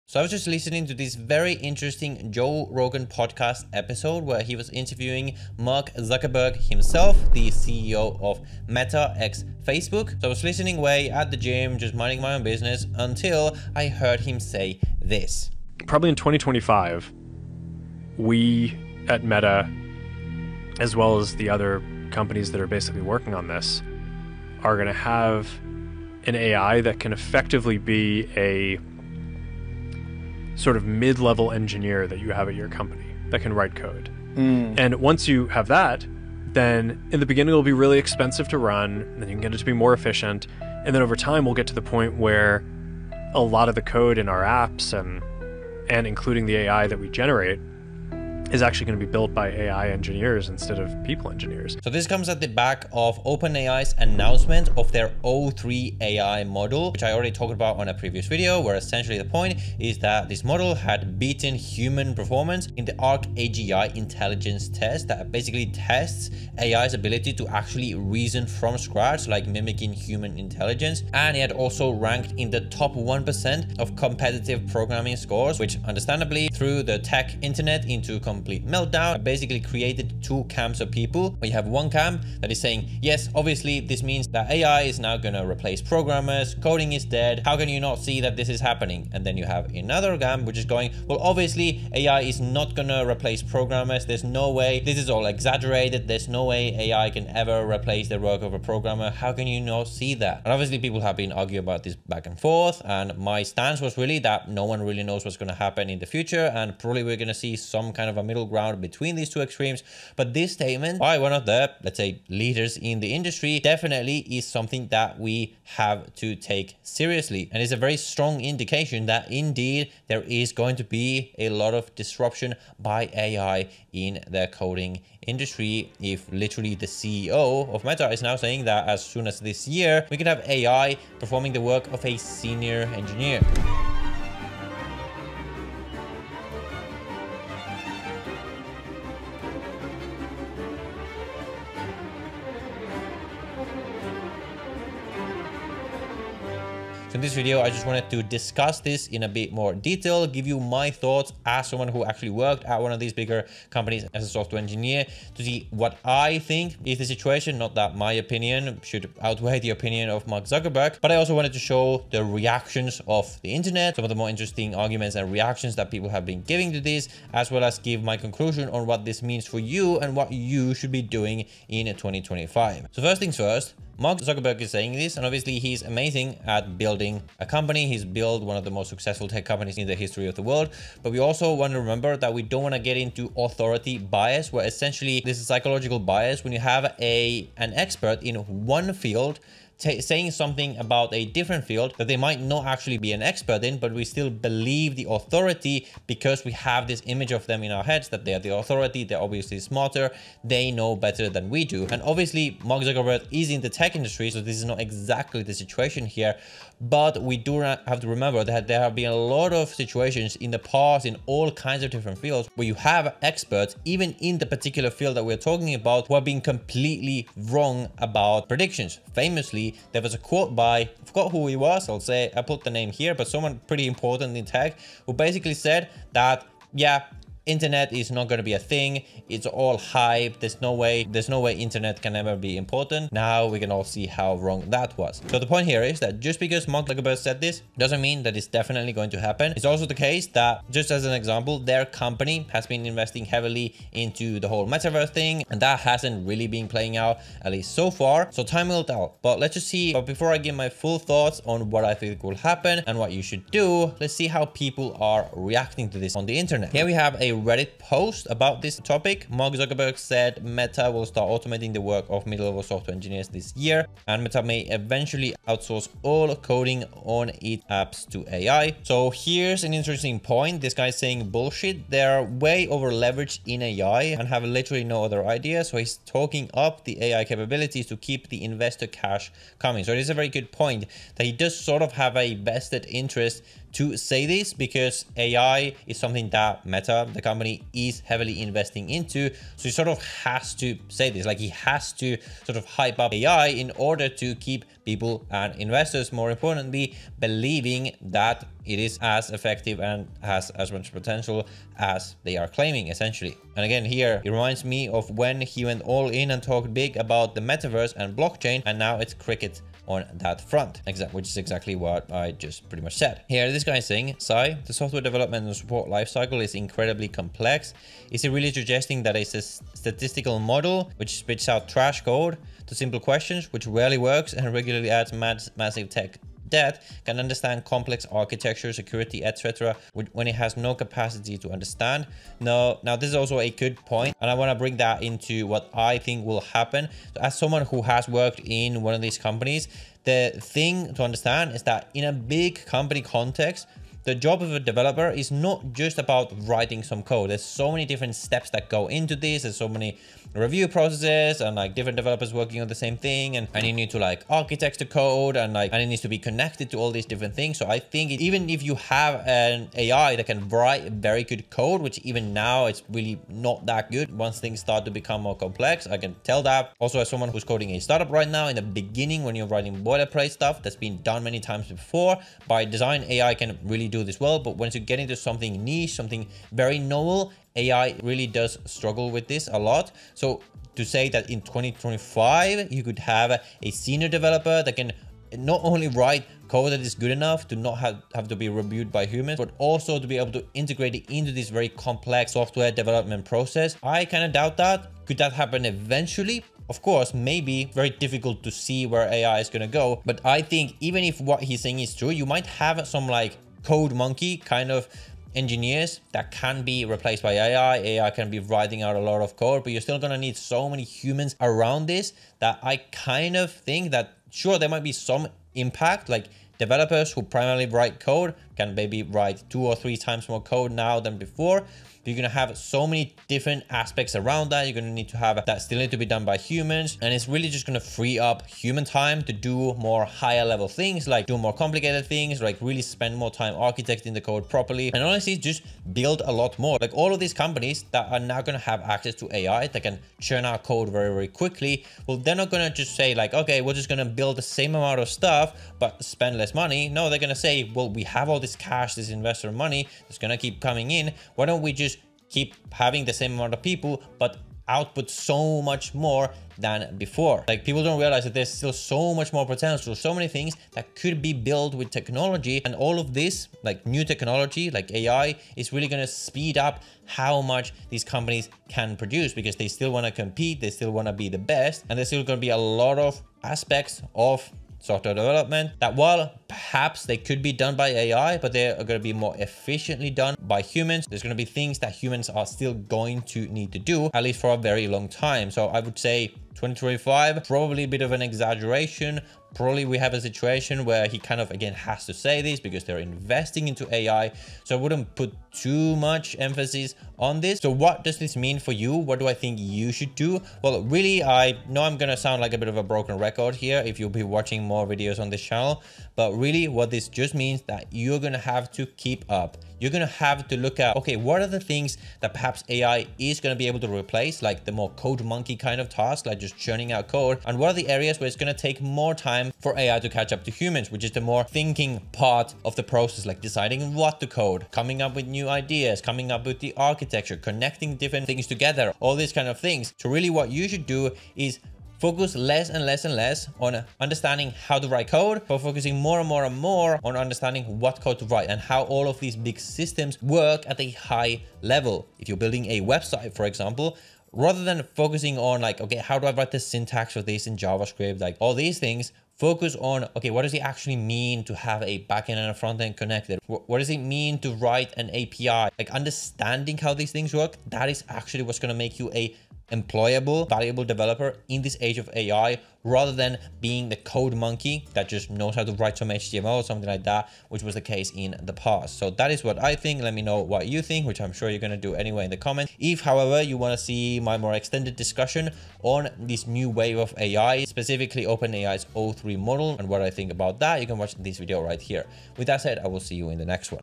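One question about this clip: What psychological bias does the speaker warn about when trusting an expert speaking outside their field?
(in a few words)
authority bias.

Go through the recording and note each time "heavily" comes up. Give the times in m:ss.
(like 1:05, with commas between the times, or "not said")
4:03, 4:48.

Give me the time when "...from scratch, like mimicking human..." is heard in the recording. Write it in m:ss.
1:08.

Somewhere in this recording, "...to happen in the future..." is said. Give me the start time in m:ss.
1:45.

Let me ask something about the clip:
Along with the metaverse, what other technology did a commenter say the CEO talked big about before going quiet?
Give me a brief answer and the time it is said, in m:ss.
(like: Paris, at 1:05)
blockchain, at 5:08.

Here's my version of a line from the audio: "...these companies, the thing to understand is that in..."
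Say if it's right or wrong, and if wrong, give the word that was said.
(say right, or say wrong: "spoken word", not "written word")
right.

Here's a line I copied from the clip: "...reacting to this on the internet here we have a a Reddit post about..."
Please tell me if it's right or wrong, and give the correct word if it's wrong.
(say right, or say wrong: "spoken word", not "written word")
right.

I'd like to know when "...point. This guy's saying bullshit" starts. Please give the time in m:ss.
4:30.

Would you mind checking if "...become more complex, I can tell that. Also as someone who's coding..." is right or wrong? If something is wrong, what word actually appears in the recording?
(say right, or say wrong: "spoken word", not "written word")
right.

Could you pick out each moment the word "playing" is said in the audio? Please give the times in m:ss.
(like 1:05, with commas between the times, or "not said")
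4:06.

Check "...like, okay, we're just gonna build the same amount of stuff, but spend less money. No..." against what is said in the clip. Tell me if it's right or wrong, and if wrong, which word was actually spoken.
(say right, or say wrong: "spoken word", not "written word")
right.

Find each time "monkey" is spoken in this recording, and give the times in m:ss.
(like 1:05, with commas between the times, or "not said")
6:43, 8:35, 9:24.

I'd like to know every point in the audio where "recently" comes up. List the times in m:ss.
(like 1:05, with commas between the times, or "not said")
not said.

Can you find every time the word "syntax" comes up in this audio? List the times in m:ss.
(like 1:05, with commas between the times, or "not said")
9:06.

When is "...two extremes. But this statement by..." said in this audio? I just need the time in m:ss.
1:49.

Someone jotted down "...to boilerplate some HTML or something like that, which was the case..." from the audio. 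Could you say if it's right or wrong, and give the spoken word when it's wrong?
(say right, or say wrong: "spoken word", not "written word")
wrong: "write", not "boilerplate".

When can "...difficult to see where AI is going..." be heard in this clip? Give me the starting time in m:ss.
6:37.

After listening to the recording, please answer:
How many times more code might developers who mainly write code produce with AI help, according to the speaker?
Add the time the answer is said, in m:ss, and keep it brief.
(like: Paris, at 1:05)
two or three times, at 6:59.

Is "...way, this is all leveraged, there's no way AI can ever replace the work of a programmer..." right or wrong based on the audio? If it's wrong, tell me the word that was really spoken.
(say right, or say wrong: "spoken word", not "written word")
wrong: "exaggerated", not "leveraged".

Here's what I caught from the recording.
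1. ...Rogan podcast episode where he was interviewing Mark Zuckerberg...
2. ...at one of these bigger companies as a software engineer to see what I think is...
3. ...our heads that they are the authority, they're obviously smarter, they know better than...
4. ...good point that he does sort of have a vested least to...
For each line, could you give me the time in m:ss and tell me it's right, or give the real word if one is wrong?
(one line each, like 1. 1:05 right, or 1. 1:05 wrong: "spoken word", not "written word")
1. 0:02 right
2. 2:32 right
3. 3:17 right
4. 4:40 wrong: "interest", not "least".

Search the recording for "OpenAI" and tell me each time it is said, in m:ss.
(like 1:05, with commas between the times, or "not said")
0:53, 9:38.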